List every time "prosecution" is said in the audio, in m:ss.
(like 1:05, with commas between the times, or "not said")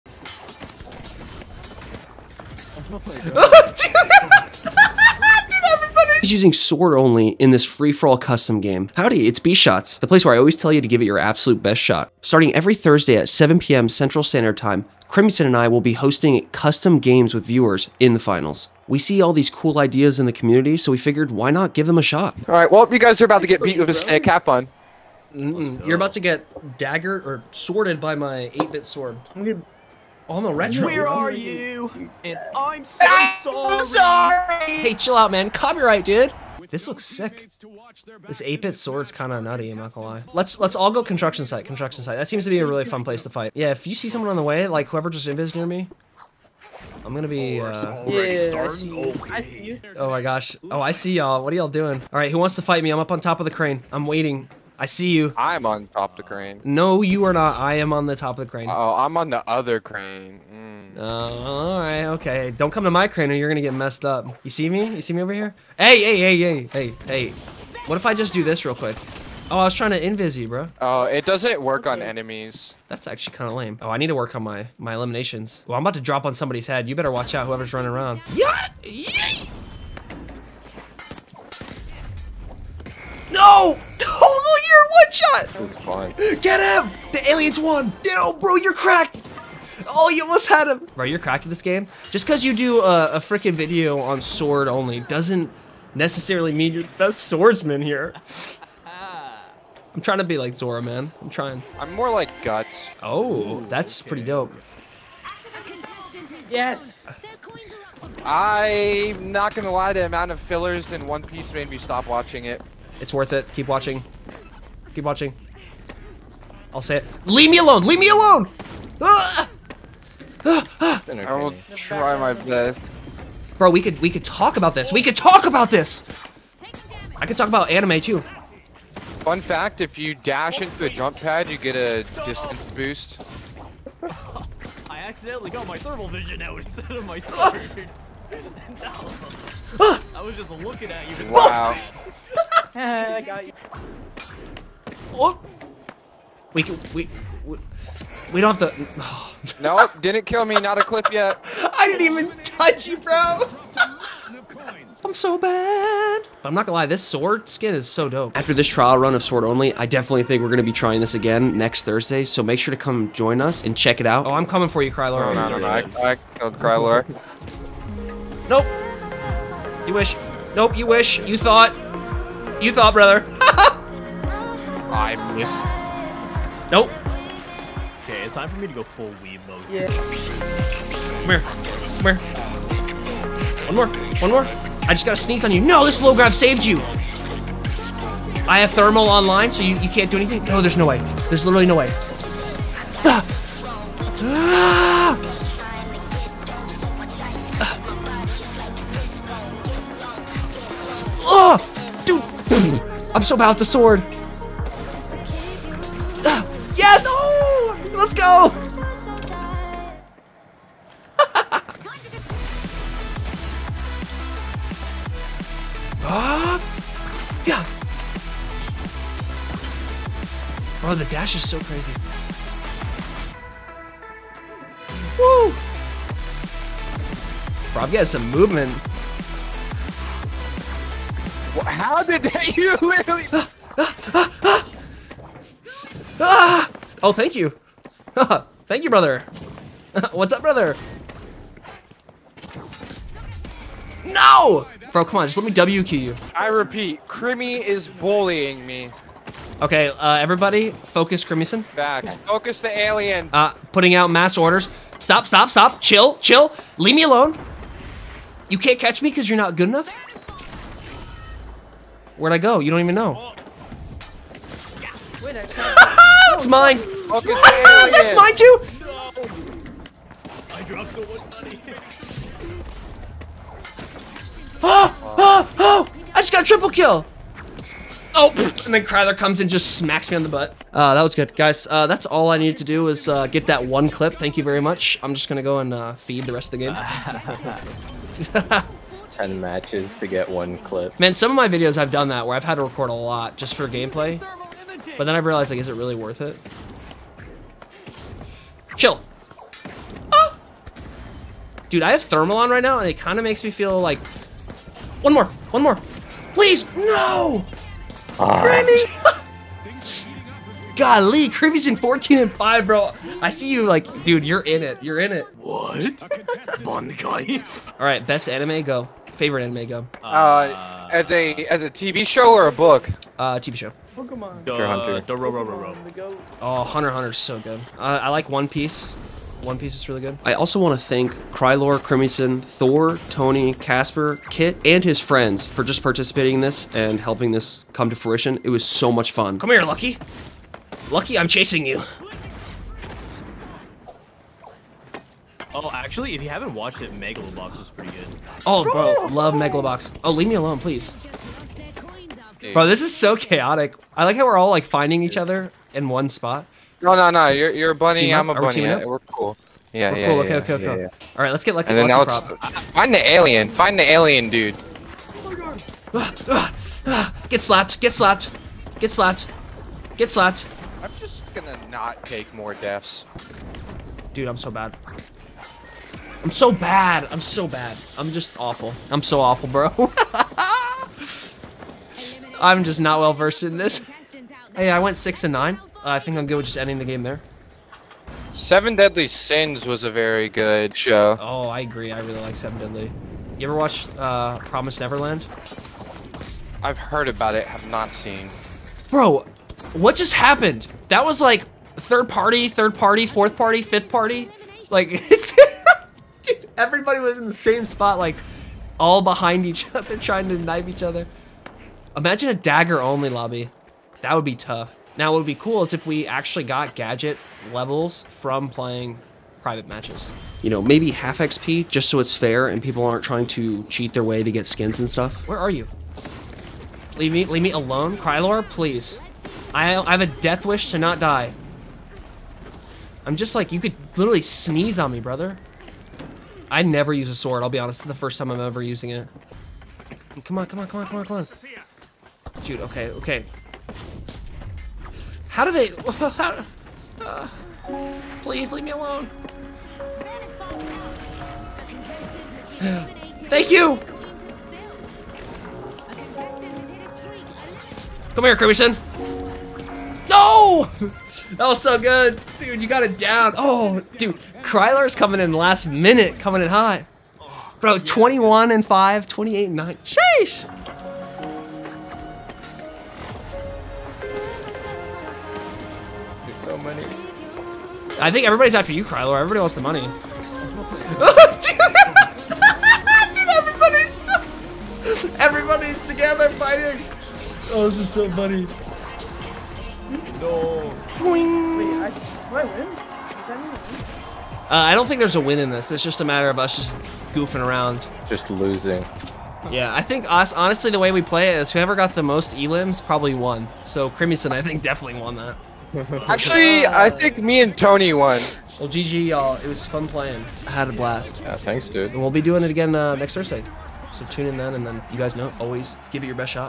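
not said.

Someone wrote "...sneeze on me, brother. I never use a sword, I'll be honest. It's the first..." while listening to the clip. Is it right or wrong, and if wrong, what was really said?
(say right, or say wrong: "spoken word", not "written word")
right.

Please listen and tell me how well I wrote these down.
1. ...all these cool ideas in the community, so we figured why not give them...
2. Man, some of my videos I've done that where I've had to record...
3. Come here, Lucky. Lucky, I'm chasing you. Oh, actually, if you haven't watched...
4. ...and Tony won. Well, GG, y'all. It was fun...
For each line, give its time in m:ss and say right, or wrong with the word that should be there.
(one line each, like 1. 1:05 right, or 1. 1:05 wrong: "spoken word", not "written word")
1. 0:19 right
2. 4:50 right
3. 5:39 right
4. 8:27 right.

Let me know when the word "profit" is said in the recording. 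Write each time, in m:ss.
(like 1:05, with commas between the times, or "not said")
not said.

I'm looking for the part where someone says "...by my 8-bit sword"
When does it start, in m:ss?
0:27.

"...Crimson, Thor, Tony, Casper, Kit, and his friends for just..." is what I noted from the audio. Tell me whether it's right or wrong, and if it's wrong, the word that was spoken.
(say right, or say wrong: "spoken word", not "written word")
right.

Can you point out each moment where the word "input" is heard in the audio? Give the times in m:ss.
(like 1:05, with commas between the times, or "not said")
not said.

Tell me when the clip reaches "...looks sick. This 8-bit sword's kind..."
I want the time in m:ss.
0:36.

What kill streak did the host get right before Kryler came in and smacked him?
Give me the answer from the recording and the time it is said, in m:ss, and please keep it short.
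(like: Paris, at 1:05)
Triple kill, at 4:36.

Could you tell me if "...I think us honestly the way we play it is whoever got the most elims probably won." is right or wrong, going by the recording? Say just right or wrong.
right.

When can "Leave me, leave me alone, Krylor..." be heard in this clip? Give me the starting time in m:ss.
7:06.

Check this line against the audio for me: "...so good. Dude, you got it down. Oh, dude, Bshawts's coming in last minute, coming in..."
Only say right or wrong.
wrong.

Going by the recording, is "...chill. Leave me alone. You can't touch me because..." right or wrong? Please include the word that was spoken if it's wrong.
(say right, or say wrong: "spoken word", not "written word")
wrong: "catch", not "touch".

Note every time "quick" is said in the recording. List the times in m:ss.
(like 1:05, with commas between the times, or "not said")
1:08.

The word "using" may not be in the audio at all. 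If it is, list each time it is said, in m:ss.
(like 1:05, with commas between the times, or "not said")
0:06, 7:18.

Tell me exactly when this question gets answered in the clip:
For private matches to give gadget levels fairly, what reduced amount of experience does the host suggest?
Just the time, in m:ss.
7:00.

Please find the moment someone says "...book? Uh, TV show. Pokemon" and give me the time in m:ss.
5:22.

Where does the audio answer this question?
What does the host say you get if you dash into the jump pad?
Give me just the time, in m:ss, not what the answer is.
2:12.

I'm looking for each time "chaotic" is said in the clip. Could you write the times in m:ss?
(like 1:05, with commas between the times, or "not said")
5:53.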